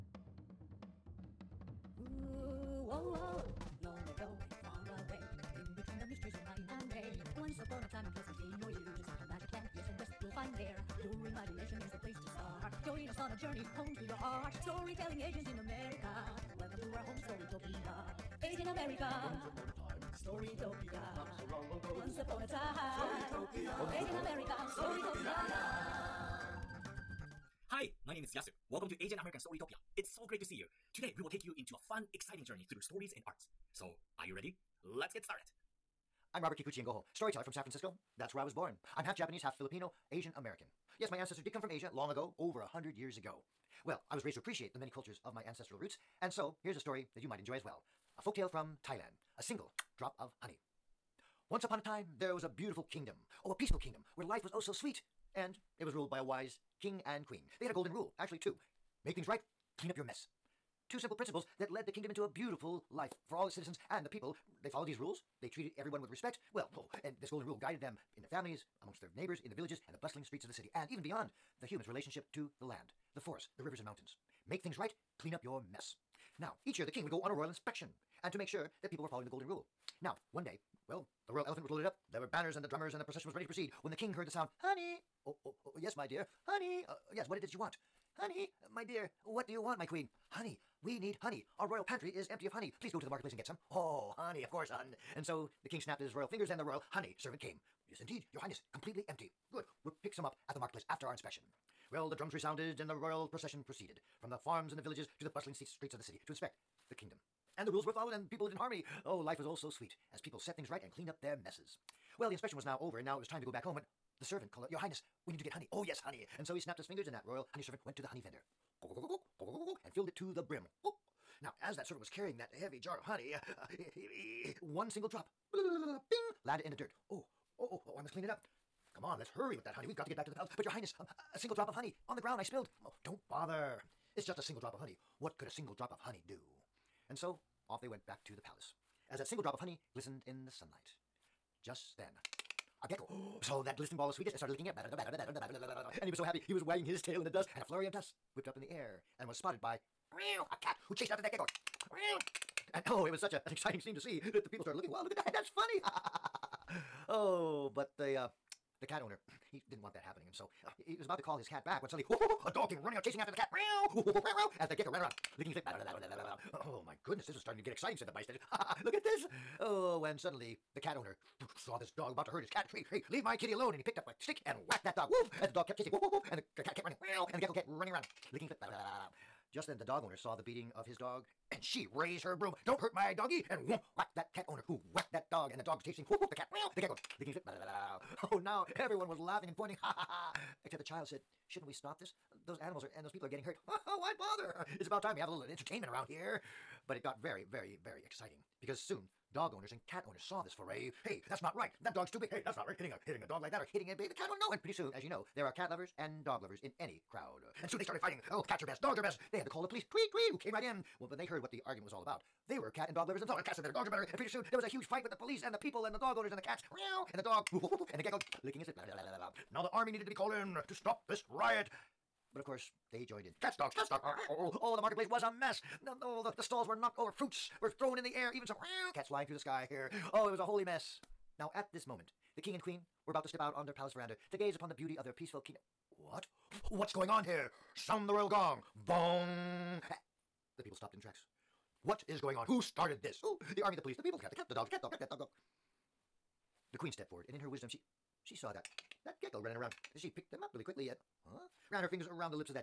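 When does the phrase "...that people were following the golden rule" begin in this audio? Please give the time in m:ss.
1:18.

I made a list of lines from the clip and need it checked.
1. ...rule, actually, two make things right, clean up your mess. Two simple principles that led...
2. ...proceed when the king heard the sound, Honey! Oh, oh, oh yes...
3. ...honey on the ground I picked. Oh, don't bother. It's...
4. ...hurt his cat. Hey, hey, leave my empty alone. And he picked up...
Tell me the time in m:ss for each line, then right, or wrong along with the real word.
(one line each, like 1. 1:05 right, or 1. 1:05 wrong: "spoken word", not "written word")
1. 0:57 right
2. 1:23 right
3. 2:11 wrong: "spilled", not "picked"
4. 2:52 wrong: "kitty", not "empty".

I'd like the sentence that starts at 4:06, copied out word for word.
The queen stepped forward, and in her wisdom, she she saw that that gecko running around.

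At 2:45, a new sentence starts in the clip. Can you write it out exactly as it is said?
Oh my goodness, this is starting to get exciting, said the bystander.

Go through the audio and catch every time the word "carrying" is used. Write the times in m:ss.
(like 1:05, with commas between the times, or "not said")
2:02.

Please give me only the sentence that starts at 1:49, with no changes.
Oh, life was all so sweet as people set things right and cleaned up their messes.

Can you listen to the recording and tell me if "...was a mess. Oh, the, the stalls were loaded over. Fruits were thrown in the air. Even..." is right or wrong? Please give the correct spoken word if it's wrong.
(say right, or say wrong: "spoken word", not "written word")
wrong: "knocked", not "loaded".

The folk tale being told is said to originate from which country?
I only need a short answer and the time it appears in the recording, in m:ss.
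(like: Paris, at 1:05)
Thailand, at 0:48.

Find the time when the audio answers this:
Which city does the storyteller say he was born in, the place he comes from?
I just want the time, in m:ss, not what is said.
0:37.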